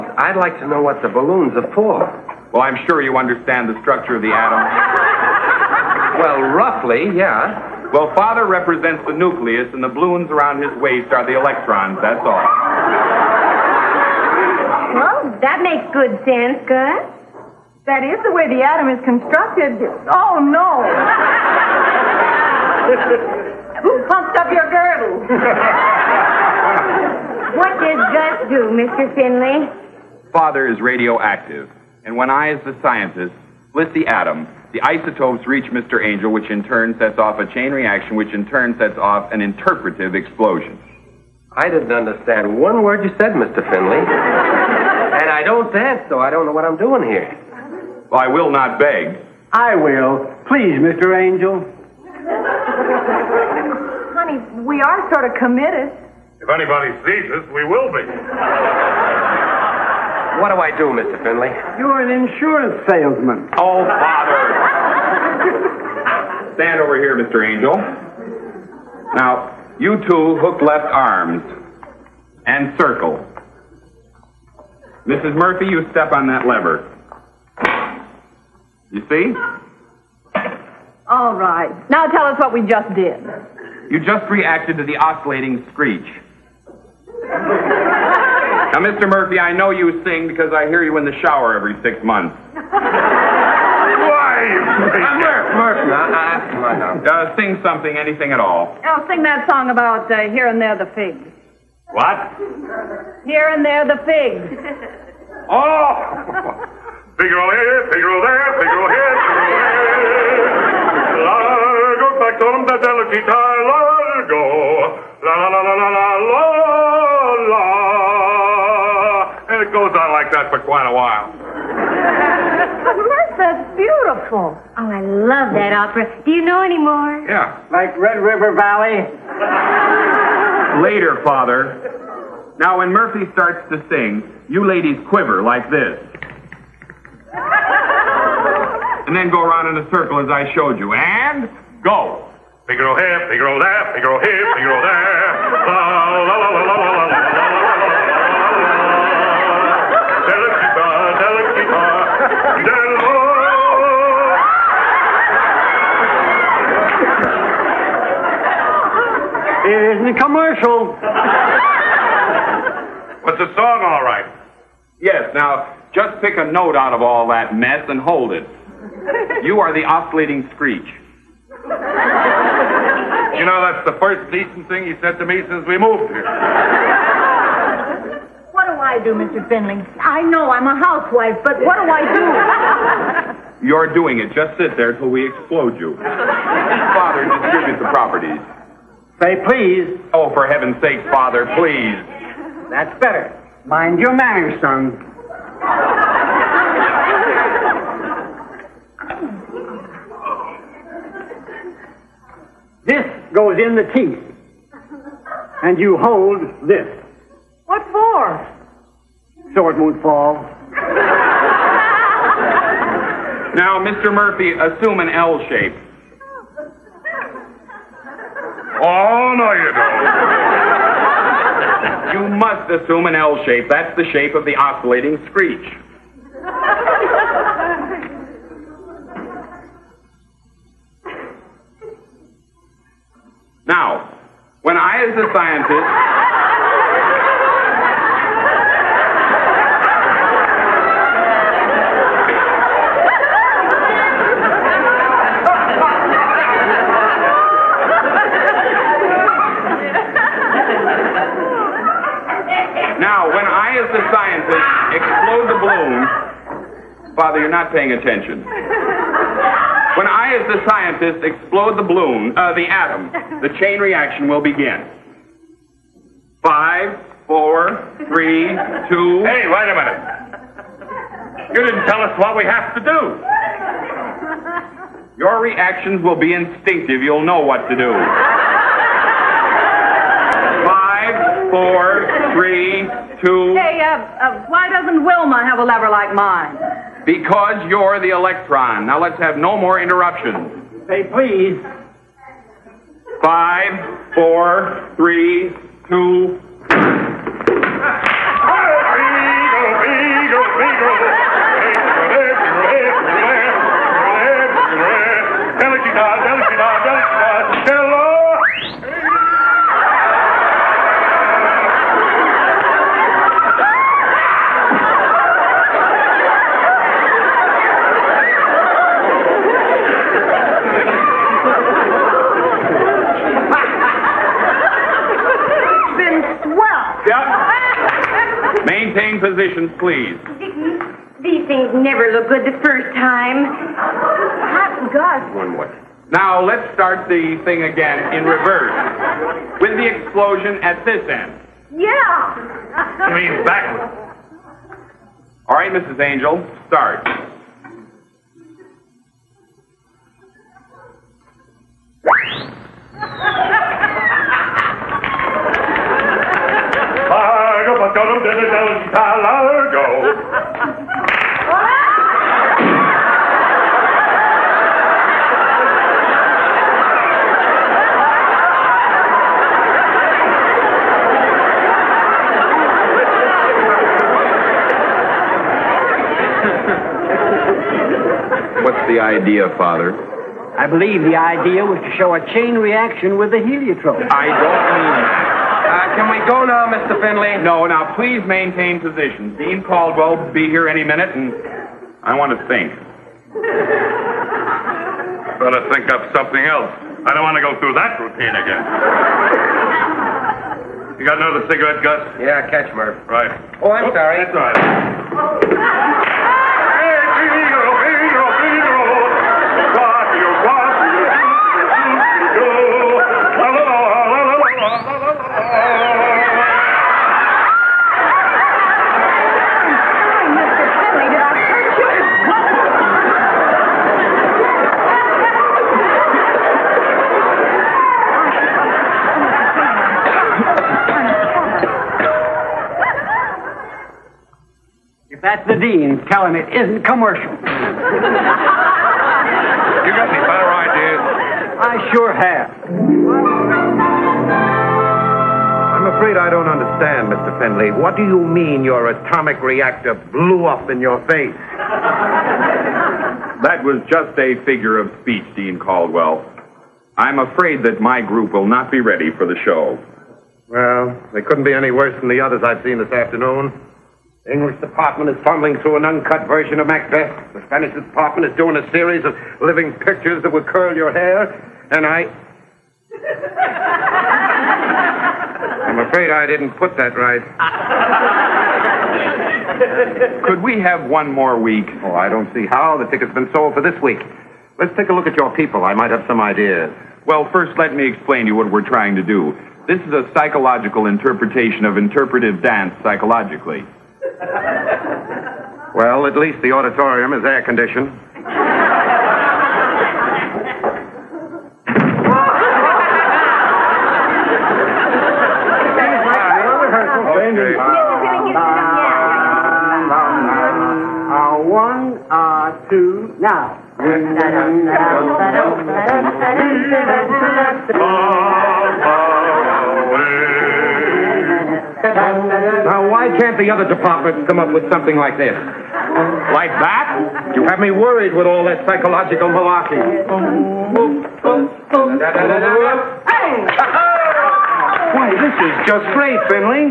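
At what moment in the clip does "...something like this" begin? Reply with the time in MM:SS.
08:44.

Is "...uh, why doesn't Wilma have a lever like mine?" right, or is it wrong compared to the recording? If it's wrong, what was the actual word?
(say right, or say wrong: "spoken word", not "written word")
right.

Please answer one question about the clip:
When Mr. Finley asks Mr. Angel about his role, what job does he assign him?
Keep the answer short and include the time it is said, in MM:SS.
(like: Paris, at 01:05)
Insurance salesman, at 01:02.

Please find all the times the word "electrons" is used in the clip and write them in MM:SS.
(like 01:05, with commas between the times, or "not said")
00:11, 04:48.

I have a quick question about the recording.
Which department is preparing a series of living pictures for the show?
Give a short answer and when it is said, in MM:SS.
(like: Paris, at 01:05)
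The Spanish department, at 07:47.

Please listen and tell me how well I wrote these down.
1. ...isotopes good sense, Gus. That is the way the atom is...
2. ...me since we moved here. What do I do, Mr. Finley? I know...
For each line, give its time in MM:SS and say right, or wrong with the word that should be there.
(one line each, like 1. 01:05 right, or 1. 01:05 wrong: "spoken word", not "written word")
1. 00:15 wrong: "makes", not "isotopes"
2. 02:55 right.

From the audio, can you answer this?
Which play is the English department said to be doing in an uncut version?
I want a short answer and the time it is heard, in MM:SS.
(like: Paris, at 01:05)
Macbeth, at 07:46.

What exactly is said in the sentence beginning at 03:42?
you must assume an L shape.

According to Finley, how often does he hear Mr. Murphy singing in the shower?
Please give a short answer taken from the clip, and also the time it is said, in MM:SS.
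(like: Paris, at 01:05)
Every six months, at 01:31.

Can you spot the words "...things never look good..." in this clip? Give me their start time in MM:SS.
05:31.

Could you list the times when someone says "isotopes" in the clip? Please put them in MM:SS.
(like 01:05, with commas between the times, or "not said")
00:34.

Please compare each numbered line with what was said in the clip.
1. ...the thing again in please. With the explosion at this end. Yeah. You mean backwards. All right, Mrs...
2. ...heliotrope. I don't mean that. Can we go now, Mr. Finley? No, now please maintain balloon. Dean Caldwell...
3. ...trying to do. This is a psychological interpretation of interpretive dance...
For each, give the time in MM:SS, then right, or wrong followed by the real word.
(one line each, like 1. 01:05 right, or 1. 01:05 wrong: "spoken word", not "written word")
1. 05:37 wrong: "reverse", not "please"
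2. 06:23 wrong: "position", not "balloon"
3. 08:08 right.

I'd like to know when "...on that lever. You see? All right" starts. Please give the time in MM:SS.
01:16.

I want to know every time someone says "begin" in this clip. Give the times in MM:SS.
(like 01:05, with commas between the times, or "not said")
04:24.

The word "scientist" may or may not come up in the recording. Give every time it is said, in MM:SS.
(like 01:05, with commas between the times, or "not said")
00:32, 03:55, 04:20.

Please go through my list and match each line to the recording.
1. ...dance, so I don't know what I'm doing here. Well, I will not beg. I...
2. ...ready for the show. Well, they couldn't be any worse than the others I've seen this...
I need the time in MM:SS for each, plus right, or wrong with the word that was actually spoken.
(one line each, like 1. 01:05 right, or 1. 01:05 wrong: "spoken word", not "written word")
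1. 00:45 right
2. 07:38 right.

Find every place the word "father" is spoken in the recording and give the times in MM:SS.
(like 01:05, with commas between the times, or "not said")
00:08, 00:30, 02:11, 03:05, 03:11, 06:19.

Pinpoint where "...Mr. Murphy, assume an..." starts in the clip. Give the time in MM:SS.
03:33.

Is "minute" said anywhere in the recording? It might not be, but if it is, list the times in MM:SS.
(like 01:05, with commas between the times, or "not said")
04:29, 06:30.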